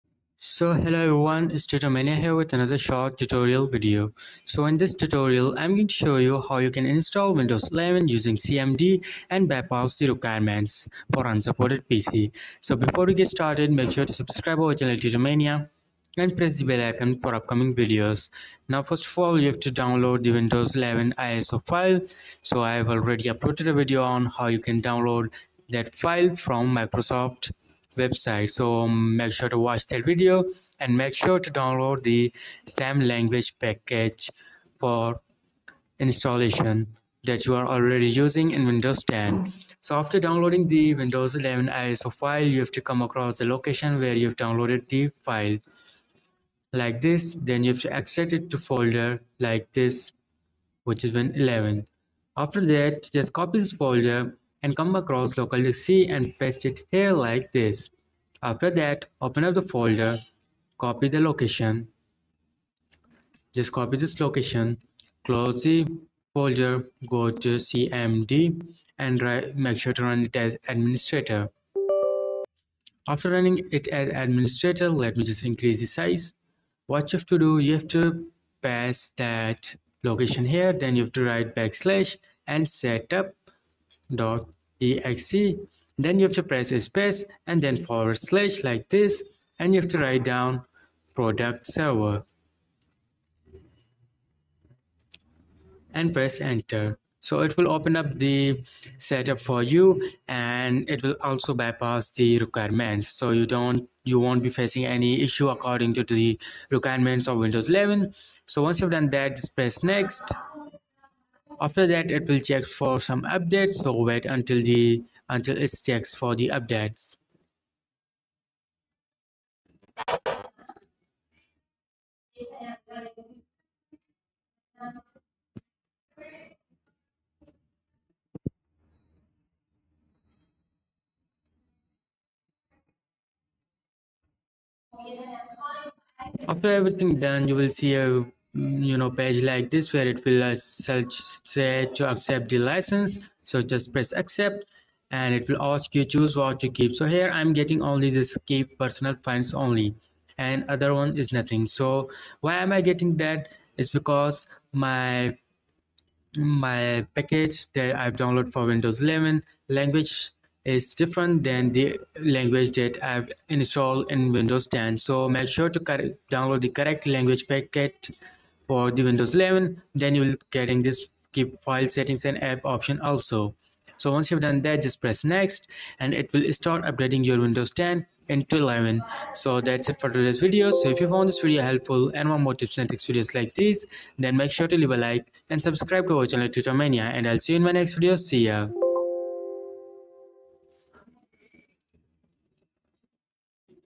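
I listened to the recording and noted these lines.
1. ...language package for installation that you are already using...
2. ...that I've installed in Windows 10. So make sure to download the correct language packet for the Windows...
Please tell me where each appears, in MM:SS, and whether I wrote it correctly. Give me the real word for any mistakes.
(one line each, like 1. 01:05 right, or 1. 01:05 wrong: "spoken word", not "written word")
1. 00:33 right
2. 02:42 right.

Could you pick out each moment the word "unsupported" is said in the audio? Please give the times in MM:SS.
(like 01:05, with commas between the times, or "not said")
00:11.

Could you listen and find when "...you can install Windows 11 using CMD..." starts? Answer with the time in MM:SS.
00:06.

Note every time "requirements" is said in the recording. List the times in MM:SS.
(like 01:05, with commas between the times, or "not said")
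00:10, 01:42, 01:46.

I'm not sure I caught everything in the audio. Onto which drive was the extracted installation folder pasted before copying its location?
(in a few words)
Local C.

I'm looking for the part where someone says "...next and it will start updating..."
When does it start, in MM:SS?
02:55.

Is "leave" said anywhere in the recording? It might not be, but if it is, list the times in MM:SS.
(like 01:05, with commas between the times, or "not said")
03:04.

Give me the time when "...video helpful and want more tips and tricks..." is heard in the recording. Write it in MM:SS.
03:01.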